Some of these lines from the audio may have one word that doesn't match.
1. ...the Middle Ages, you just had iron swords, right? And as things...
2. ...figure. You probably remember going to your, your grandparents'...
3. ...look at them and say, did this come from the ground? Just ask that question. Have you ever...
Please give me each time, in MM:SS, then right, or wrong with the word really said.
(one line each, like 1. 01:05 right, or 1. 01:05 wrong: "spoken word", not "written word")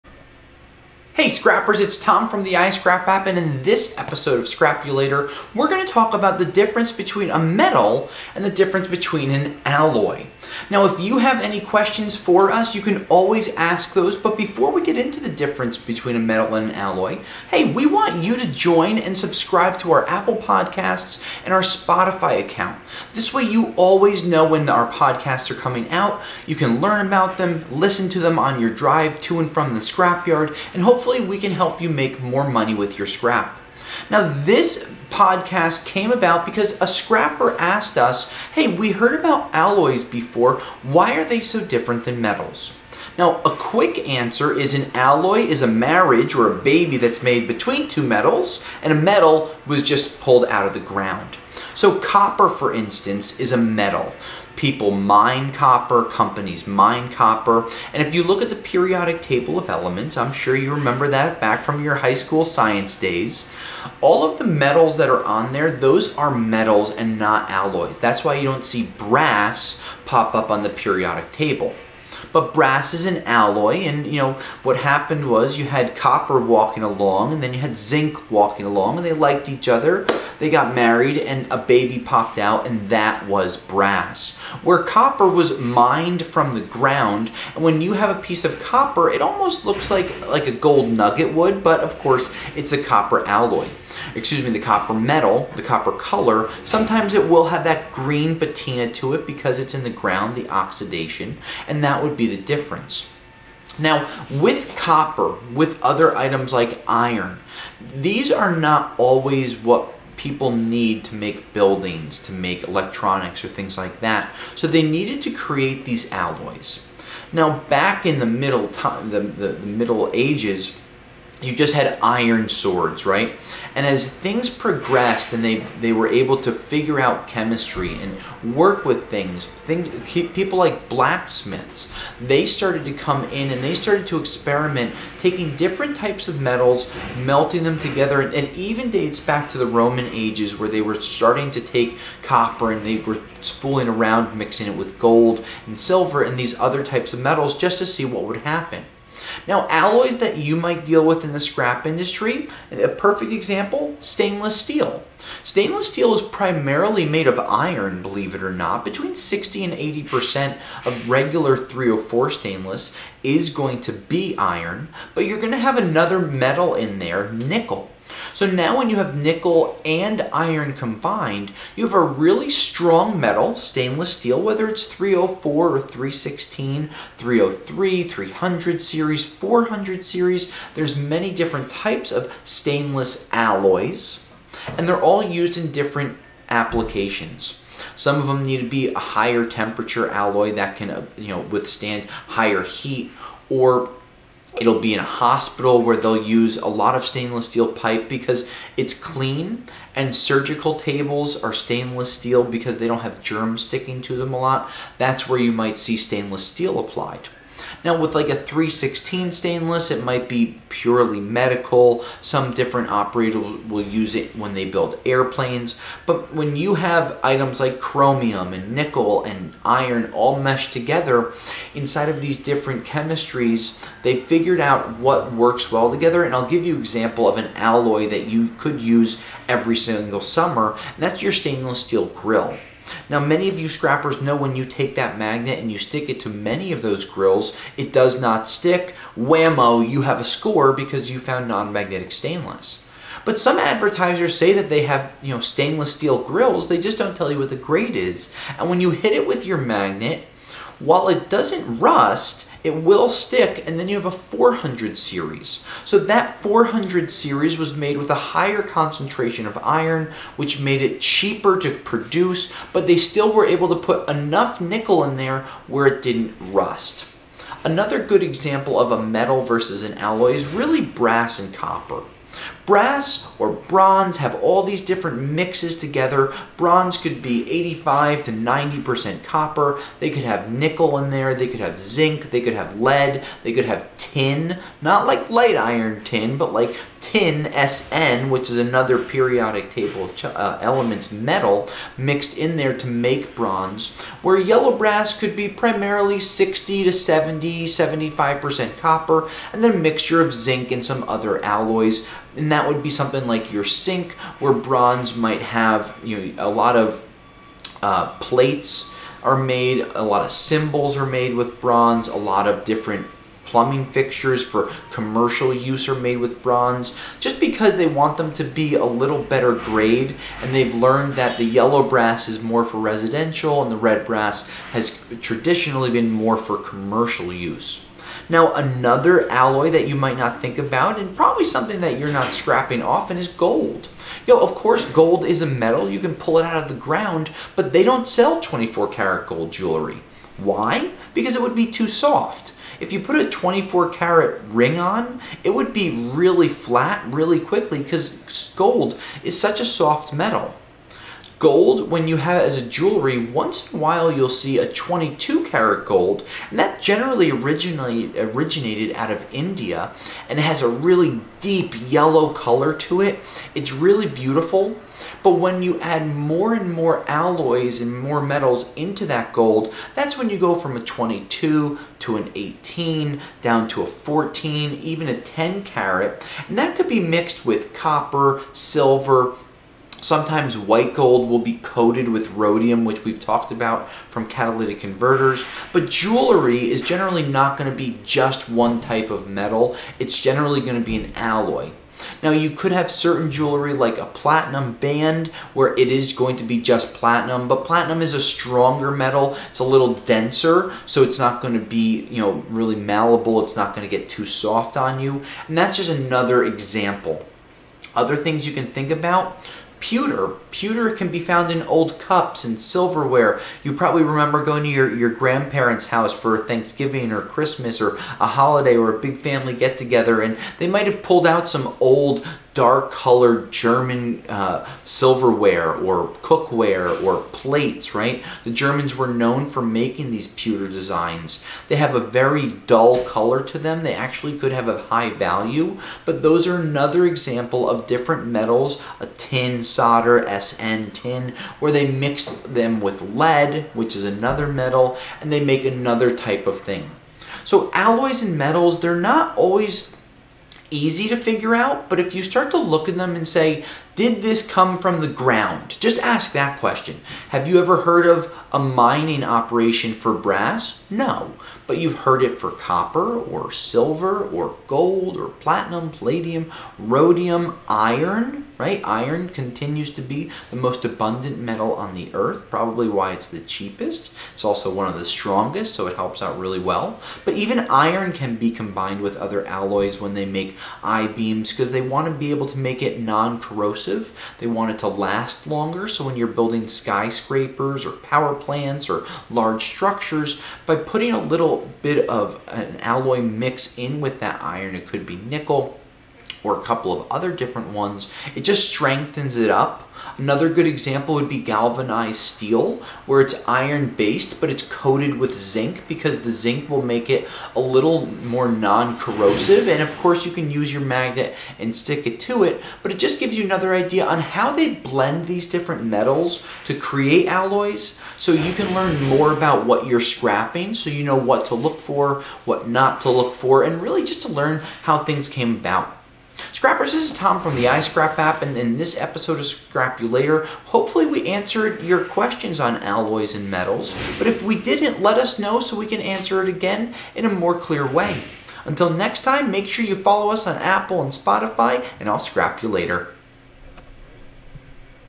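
1. 01:59 right
2. 06:52 wrong: "silverware", not "figure"
3. 07:32 right.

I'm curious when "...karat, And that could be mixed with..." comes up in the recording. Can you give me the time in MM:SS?
06:15.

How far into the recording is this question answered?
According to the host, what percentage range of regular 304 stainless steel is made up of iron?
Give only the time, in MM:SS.
02:38.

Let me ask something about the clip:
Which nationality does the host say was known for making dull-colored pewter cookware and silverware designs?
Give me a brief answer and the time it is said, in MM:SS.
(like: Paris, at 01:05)
German, at 07:08.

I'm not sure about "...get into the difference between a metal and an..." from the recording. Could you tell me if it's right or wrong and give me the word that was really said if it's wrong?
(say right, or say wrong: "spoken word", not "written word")
right.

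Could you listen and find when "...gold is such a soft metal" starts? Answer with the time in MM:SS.
05:48.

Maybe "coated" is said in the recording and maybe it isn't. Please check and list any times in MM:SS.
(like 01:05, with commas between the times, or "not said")
06:21, 08:24.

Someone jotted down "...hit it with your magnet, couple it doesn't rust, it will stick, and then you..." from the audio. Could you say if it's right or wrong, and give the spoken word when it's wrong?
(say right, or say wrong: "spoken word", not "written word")
wrong: "while", not "couple".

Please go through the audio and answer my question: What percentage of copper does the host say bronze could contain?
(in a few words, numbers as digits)
85 to 90%.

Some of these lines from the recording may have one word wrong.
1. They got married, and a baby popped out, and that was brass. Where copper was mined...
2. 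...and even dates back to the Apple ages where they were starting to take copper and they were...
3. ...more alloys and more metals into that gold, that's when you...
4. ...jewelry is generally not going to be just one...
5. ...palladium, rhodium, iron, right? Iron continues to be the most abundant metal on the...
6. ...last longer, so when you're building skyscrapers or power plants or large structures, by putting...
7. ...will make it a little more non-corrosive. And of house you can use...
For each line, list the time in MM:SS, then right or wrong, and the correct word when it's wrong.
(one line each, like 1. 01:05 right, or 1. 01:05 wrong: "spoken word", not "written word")
1. 01:20 right
2. 02:18 wrong: "Roman", not "Apple"
3. 06:06 right
4. 06:25 right
5. 07:45 right
6. 08:04 right
7. 08:26 wrong: "course", not "house".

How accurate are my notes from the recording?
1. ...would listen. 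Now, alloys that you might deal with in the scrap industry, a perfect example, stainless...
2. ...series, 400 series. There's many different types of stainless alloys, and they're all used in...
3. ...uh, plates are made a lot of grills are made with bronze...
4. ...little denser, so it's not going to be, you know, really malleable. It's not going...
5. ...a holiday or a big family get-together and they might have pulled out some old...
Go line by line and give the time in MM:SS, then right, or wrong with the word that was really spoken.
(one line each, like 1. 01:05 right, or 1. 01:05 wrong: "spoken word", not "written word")
1. 02:28 wrong: "happen", not "listen"
2. 02:58 right
3. 05:07 wrong: "cymbals", not "grills"
4. 06:39 right
5. 06:58 right.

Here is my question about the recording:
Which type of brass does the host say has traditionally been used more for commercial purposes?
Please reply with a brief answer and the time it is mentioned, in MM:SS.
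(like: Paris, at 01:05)
red brass, at 05:23.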